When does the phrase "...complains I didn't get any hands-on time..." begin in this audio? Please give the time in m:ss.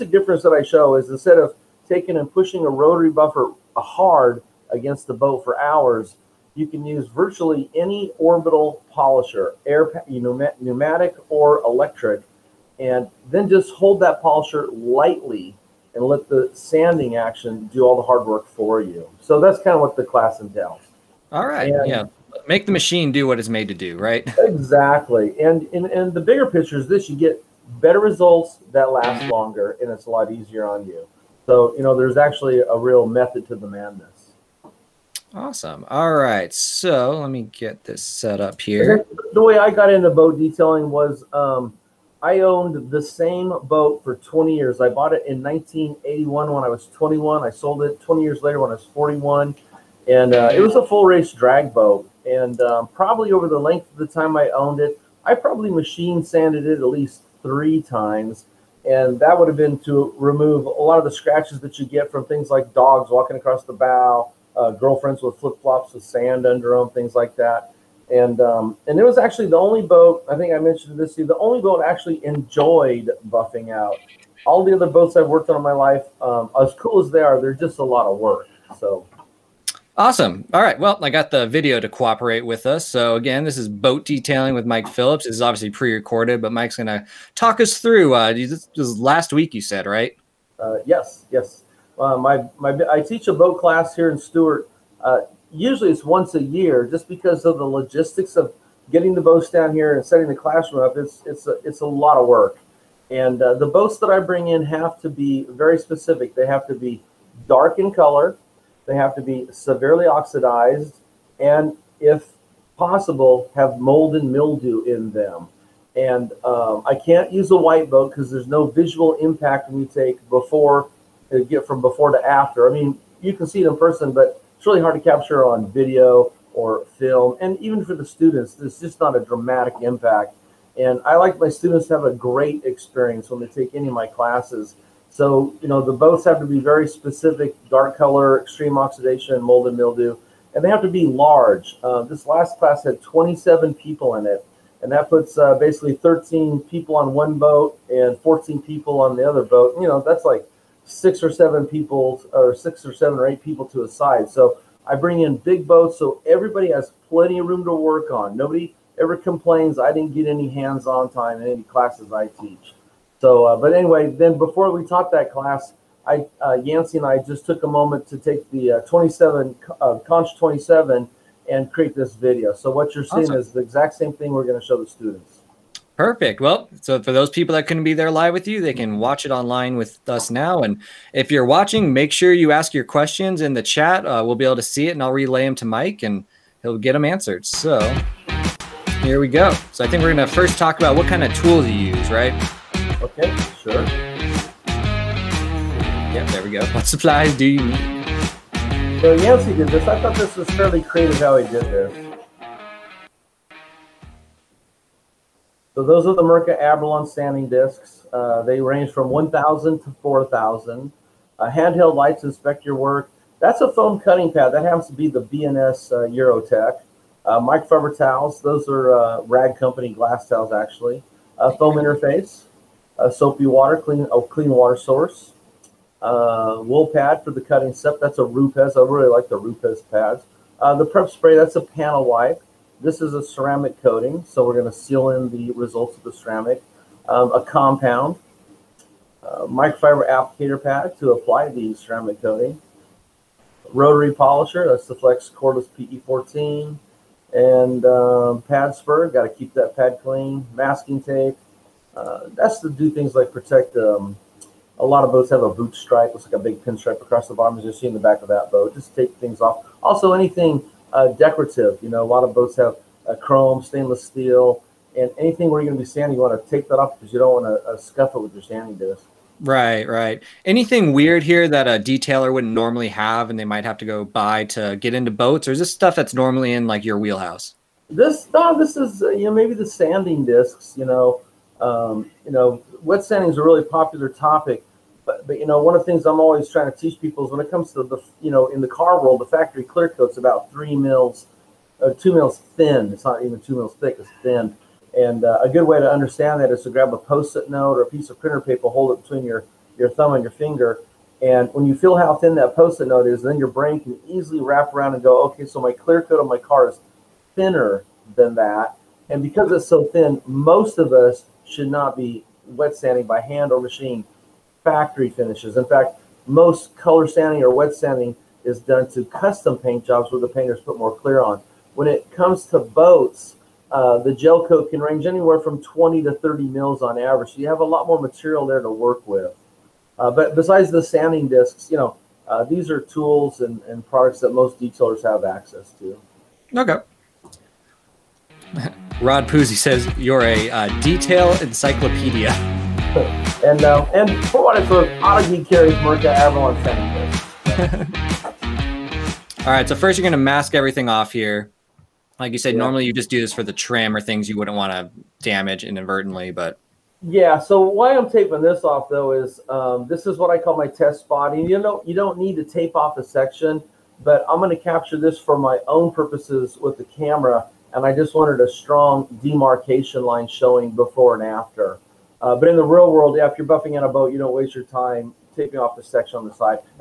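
2:39.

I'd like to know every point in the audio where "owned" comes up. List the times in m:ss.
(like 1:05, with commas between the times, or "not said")
0:42, 0:54.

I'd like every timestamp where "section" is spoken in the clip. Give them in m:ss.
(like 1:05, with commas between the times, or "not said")
6:03, 6:15.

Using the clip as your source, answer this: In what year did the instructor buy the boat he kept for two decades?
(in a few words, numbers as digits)
1981.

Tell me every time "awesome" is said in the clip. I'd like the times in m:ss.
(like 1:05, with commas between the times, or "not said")
0:35, 1:19, 2:53.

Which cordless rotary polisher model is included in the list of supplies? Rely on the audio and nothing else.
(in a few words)
Flex Cordless PE14.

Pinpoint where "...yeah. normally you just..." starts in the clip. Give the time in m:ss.
5:52.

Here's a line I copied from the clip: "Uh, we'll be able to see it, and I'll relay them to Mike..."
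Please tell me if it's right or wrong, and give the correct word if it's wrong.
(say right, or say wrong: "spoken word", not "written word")
right.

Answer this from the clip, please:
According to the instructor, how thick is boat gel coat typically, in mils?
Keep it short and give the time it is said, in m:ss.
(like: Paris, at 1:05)
20 to 30 mils, at 5:25.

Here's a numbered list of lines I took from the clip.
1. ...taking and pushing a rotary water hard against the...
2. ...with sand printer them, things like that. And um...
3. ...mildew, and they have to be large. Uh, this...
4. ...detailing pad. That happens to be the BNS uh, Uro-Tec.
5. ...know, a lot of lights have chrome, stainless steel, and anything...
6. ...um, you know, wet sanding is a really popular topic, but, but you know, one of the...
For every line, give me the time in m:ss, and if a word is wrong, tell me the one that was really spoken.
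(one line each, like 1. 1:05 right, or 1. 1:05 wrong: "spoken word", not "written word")
1. 0:01 wrong: "buffer", not "water"
2. 1:05 wrong: "under", not "printer"
3. 2:19 right
4. 3:33 wrong: "cutting", not "detailing"
5. 4:21 wrong: "boats", not "lights"
6. 4:41 right.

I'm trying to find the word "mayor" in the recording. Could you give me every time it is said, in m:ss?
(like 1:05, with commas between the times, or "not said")
not said.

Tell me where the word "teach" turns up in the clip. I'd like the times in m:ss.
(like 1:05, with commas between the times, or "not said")
1:33, 2:42, 4:46.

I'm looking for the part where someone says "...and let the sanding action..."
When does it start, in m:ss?
0:15.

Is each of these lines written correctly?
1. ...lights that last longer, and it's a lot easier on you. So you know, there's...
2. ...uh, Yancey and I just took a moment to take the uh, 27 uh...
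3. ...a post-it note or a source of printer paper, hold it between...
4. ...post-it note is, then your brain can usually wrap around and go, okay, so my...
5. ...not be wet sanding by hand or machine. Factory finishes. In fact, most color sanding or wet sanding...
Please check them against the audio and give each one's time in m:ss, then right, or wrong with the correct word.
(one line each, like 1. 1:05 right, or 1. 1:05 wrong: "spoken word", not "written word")
1. 0:27 wrong: "results", not "lights"
2. 2:46 right
3. 4:56 wrong: "piece", not "source"
4. 5:02 wrong: "easily", not "usually"
5. 5:11 right.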